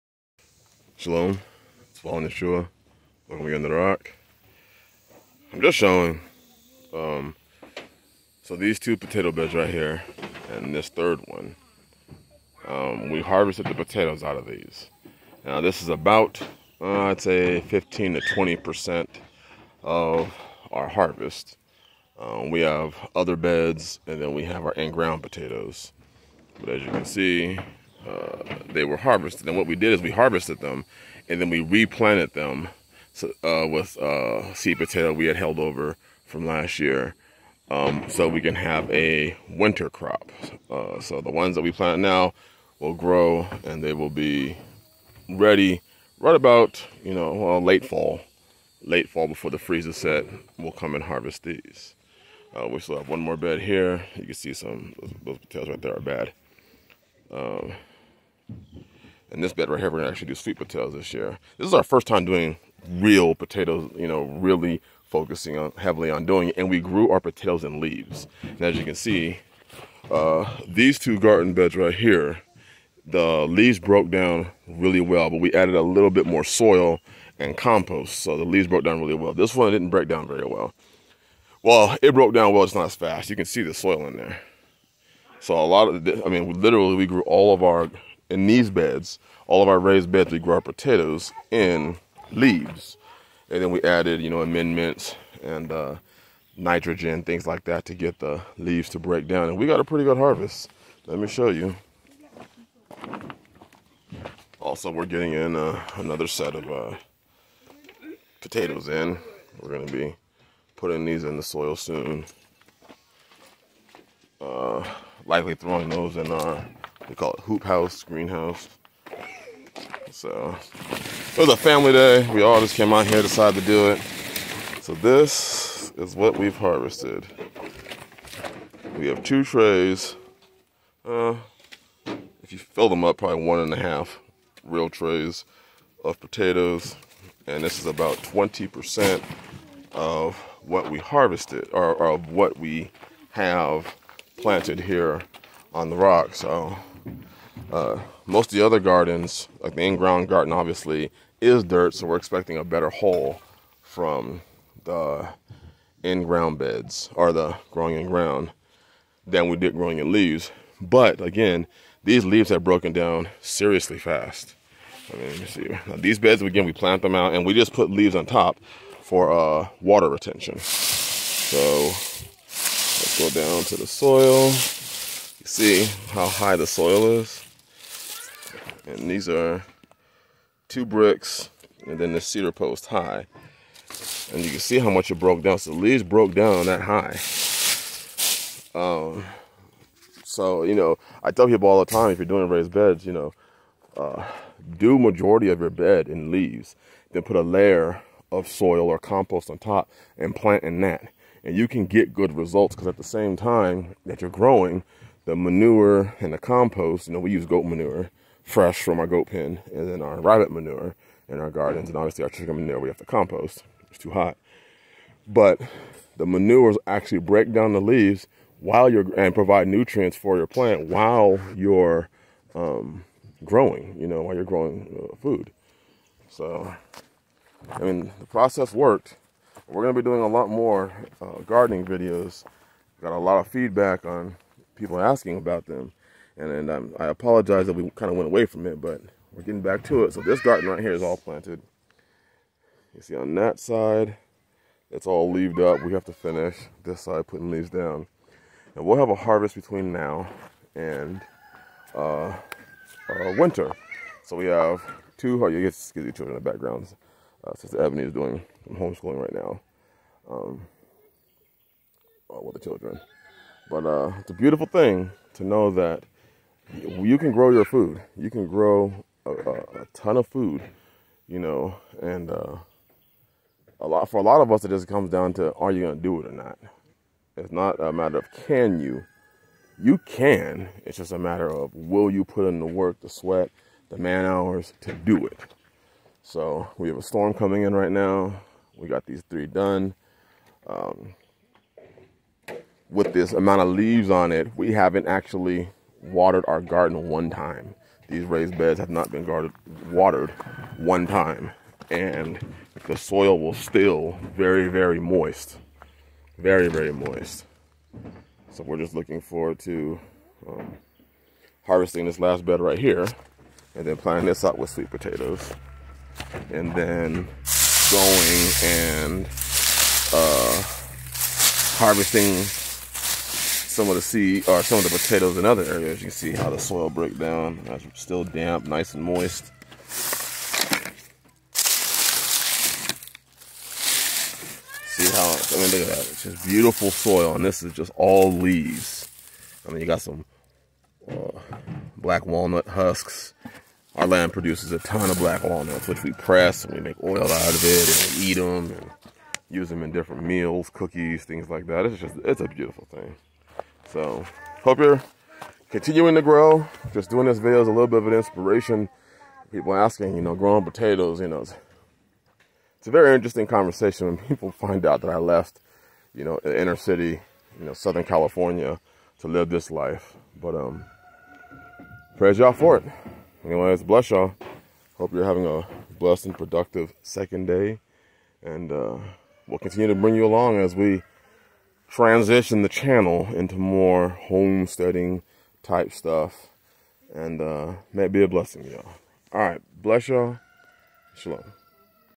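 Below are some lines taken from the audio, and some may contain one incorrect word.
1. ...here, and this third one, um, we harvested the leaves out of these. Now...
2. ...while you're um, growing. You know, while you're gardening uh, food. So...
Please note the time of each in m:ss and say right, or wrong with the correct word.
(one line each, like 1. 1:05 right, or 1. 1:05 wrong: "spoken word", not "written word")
1. 0:09 wrong: "potatoes", not "leaves"
2. 3:40 wrong: "growing", not "gardening".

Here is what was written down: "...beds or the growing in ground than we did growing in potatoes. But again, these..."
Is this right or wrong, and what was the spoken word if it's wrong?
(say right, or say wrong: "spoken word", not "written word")
wrong: "leaves", not "potatoes".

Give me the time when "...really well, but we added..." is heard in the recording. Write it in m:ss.
1:14.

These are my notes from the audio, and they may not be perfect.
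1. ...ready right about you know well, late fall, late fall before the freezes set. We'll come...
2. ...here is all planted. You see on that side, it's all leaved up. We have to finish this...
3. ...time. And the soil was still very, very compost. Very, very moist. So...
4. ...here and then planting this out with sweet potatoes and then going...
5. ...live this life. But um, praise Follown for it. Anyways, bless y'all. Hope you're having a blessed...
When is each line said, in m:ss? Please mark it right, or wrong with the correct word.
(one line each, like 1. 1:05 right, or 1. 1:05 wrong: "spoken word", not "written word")
1. 0:45 right
2. 4:00 right
3. 5:01 wrong: "moist", not "compost"
4. 5:12 right
5. 6:09 wrong: "Yah", not "Follown".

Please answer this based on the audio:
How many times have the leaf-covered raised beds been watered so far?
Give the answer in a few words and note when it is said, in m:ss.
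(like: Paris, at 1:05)
0, at 4:54.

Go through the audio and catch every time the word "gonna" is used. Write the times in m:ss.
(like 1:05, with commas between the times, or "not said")
0:59, 3:49.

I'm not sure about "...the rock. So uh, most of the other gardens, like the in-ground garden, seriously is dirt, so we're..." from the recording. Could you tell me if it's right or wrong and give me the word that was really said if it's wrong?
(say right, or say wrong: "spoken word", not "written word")
wrong: "obviously", not "seriously".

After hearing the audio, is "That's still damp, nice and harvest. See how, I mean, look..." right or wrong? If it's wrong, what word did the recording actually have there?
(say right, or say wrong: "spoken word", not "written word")
wrong: "moist", not "harvest".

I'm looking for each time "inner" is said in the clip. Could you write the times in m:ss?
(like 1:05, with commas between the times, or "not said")
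6:06.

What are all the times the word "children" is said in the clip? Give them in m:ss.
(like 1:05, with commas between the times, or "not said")
4:16, 4:22.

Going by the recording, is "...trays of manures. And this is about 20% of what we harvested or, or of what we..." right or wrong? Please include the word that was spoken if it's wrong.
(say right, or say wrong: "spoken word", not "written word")
wrong: "potatoes", not "manures".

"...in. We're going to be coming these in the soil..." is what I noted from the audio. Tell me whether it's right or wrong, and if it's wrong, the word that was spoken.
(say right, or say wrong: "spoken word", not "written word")
wrong: "putting", not "coming".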